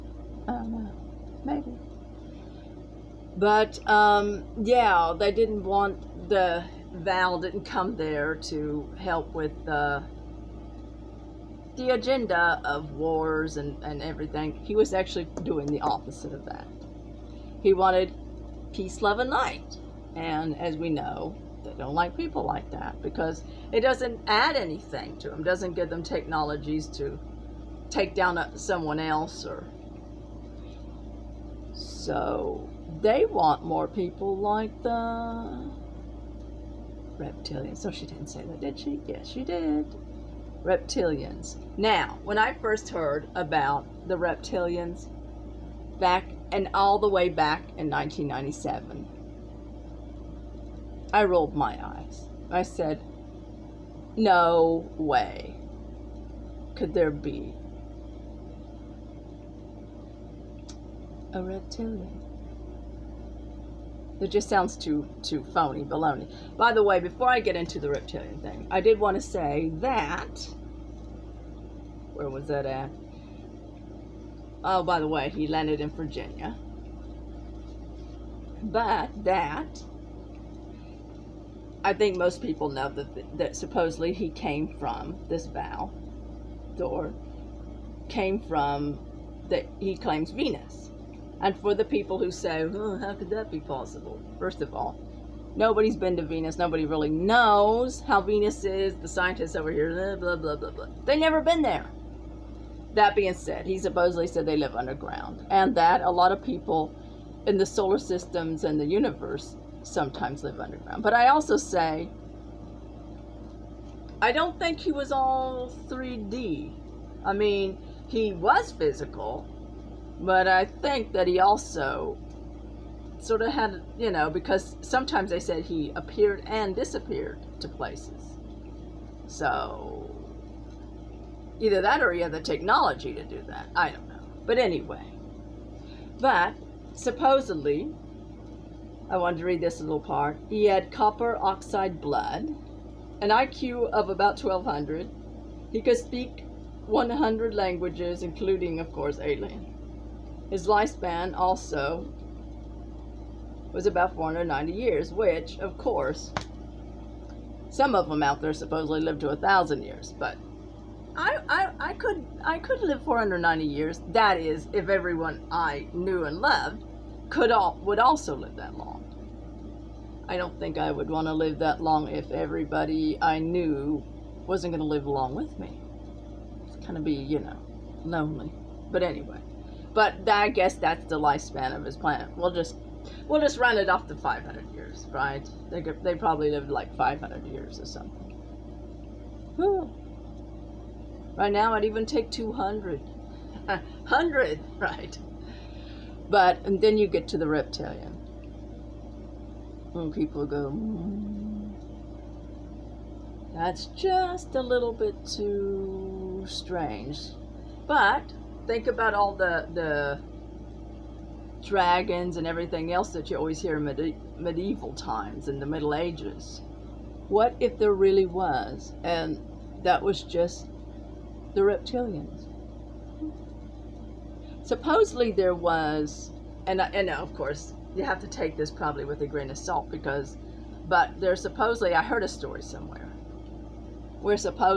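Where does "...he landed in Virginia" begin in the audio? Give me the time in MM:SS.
01:15.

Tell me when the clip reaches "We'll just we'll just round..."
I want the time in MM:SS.
03:02.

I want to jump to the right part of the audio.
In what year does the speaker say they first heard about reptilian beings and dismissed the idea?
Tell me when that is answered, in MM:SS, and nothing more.
00:47.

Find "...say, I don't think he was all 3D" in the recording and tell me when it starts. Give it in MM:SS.
01:51.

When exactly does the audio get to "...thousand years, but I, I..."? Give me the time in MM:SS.
02:39.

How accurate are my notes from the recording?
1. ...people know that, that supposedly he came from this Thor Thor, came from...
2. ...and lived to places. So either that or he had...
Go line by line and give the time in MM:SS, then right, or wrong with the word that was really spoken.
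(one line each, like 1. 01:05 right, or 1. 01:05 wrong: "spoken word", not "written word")
1. 01:22 wrong: "Val", not "Thor"
2. 02:06 wrong: "disappeared", not "lived".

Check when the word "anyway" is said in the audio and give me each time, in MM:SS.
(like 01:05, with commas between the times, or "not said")
02:14, 02:59.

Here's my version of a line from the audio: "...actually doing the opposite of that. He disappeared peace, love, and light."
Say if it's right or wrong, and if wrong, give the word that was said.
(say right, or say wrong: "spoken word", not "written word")
wrong: "wanted", not "disappeared".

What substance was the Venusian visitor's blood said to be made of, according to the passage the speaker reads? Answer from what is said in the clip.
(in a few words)
Copper oxide.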